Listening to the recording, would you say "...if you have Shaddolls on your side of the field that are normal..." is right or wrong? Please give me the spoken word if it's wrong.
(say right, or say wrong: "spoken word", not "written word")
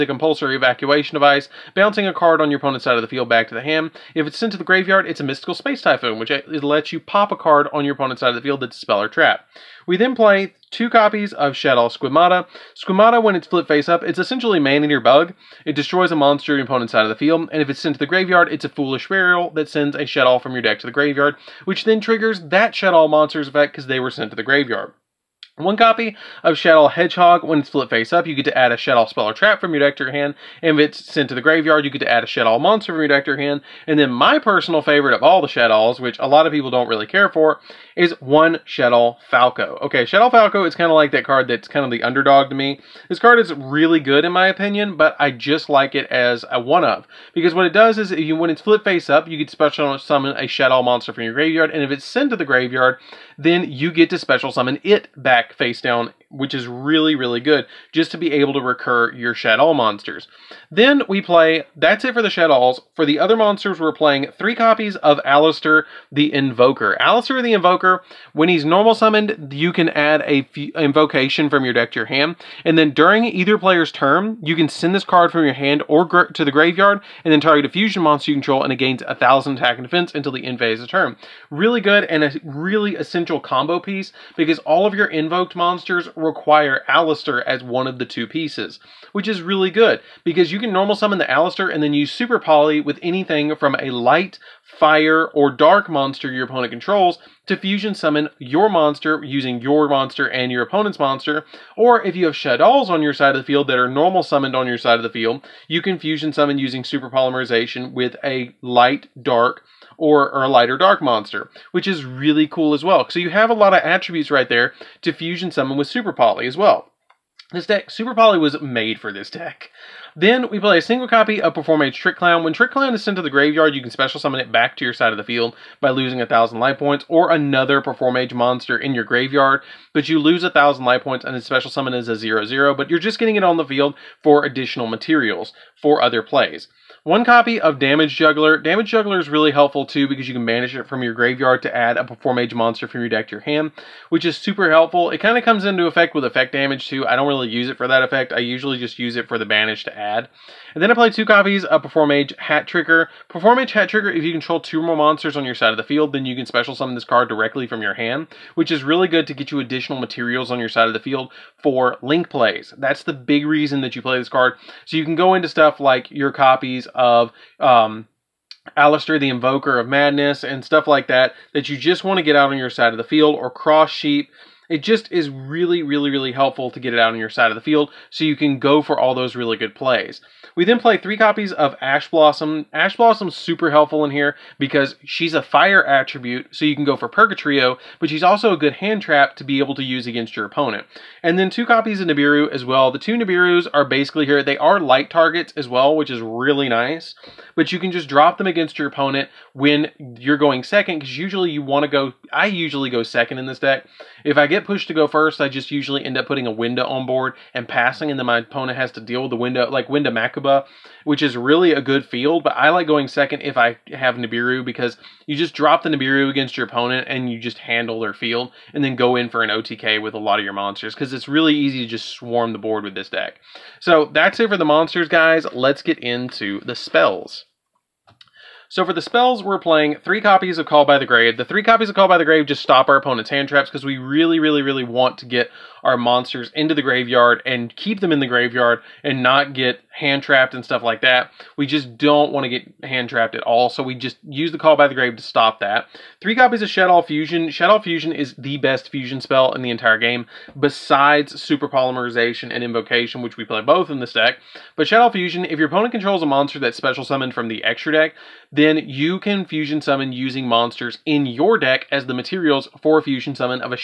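right.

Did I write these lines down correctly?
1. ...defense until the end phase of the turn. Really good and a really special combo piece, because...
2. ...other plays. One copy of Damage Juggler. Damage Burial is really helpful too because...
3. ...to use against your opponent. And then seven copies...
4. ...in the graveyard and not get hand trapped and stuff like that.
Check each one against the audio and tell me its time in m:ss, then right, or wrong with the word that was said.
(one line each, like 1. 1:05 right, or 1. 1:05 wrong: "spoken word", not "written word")
1. 1:19 wrong: "essential", not "special"
2. 2:16 wrong: "Juggler", not "Burial"
3. 3:09 wrong: "two", not "seven"
4. 3:58 right.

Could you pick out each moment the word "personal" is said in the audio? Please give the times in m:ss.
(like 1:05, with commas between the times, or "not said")
0:34.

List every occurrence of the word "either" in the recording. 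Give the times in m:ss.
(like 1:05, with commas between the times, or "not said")
1:13.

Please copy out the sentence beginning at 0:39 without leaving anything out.
Okay, Shaddoll Falco is kind of like that card that's kind of the underdog to me.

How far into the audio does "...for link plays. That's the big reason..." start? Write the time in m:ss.
2:41.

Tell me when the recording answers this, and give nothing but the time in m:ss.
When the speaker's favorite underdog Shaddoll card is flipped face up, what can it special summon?
0:50.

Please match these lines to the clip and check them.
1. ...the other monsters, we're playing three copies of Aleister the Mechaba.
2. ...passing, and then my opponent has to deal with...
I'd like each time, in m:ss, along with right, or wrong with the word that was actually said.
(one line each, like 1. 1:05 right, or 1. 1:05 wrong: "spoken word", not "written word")
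1. 1:03 wrong: "Invoker", not "Mechaba"
2. 3:27 right.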